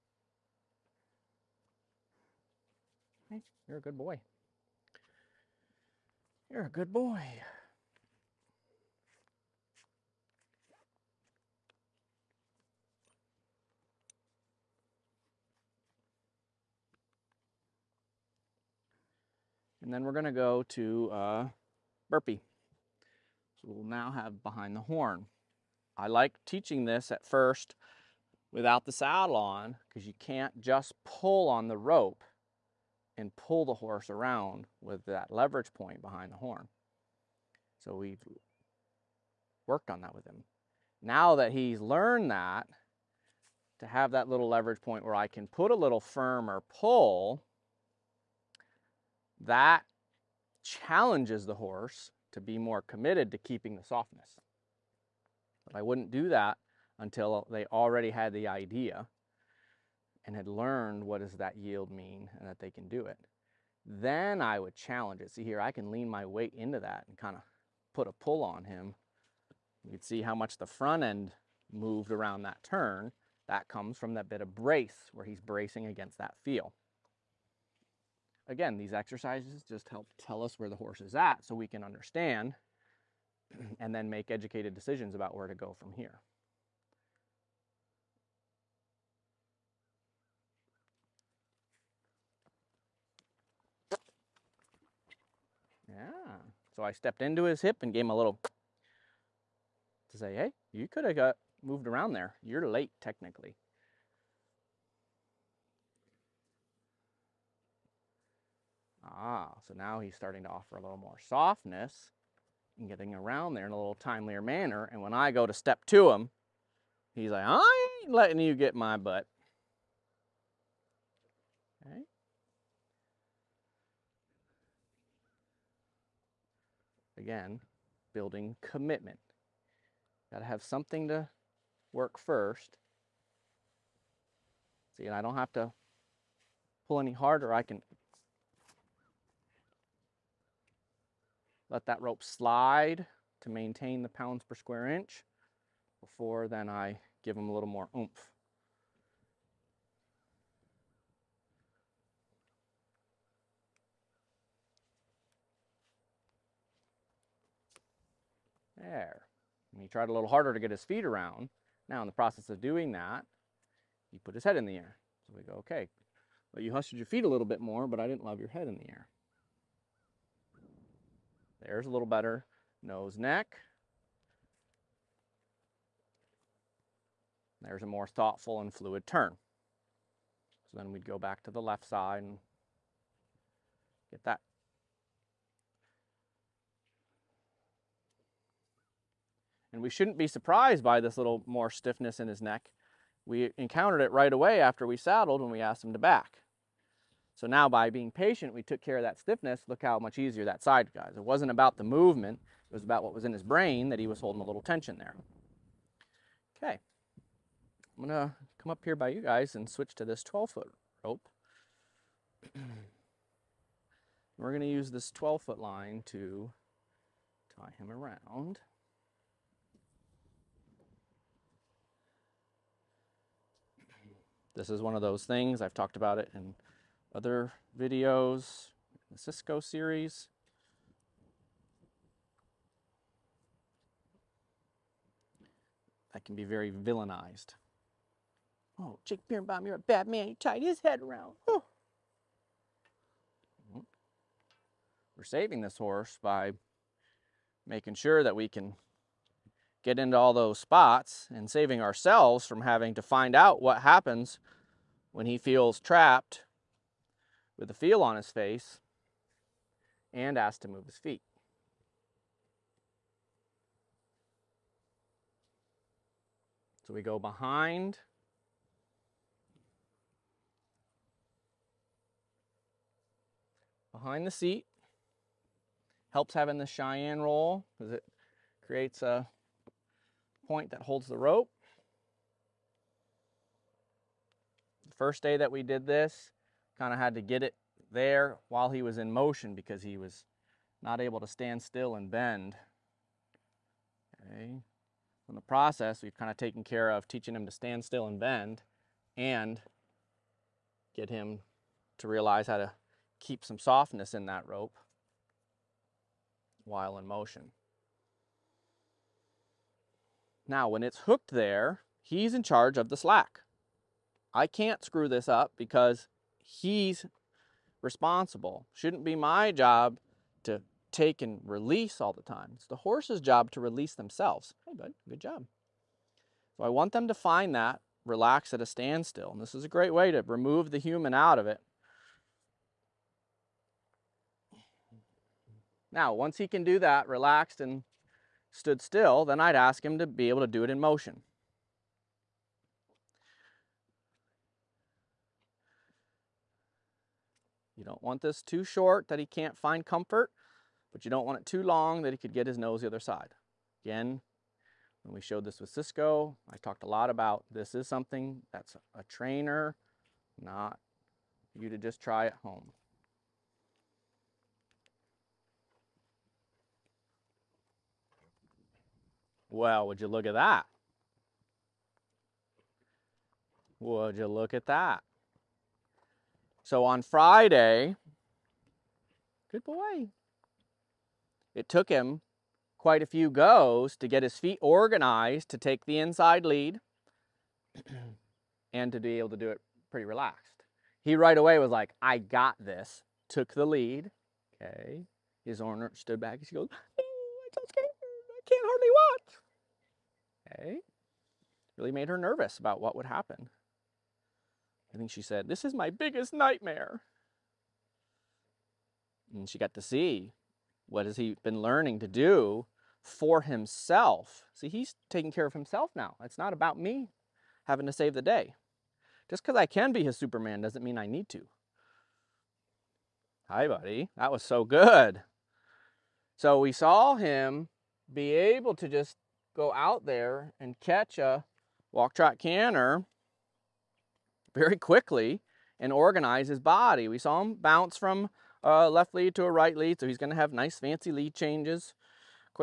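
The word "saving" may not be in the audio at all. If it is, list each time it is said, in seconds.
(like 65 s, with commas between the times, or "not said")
245 s, 251 s.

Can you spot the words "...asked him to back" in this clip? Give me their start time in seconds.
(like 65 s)
195 s.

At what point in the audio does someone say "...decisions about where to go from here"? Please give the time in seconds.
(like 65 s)
84 s.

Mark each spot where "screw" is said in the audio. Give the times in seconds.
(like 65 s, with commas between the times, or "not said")
314 s.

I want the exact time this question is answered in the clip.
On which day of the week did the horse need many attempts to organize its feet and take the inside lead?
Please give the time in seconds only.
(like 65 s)
377 s.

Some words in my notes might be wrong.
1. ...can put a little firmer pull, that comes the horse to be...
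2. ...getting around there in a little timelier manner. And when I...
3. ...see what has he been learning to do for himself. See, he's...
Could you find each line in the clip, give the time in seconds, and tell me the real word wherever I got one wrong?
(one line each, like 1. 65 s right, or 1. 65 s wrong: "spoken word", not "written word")
1. 45 s wrong: "challenges", not "comes"
2. 112 s right
3. 409 s right.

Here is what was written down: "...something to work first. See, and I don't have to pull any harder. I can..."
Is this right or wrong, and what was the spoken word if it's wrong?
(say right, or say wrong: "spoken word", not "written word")
right.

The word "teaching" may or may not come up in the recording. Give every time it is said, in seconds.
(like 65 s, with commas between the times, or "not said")
26 s, 297 s.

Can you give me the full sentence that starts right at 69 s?
You can see how much the front end moved around that turn.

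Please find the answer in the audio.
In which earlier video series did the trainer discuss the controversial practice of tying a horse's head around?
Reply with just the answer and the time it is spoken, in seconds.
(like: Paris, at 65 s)
Cisco series, at 229 s.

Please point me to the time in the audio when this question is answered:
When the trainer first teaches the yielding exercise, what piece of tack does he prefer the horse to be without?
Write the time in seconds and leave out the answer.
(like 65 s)
28 s.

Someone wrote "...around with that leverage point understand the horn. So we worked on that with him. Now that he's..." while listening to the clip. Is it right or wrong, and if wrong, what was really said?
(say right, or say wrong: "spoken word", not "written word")
wrong: "behind", not "understand".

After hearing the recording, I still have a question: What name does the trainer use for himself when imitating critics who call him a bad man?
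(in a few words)
Jake Birnbaum.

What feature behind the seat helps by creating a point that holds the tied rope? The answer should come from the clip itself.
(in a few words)
Cheyenne roll.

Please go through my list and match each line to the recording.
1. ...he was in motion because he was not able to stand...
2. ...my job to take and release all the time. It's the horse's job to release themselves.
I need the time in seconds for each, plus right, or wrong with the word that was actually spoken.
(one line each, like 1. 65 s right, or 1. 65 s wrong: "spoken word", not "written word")
1. 288 s right
2. 319 s right.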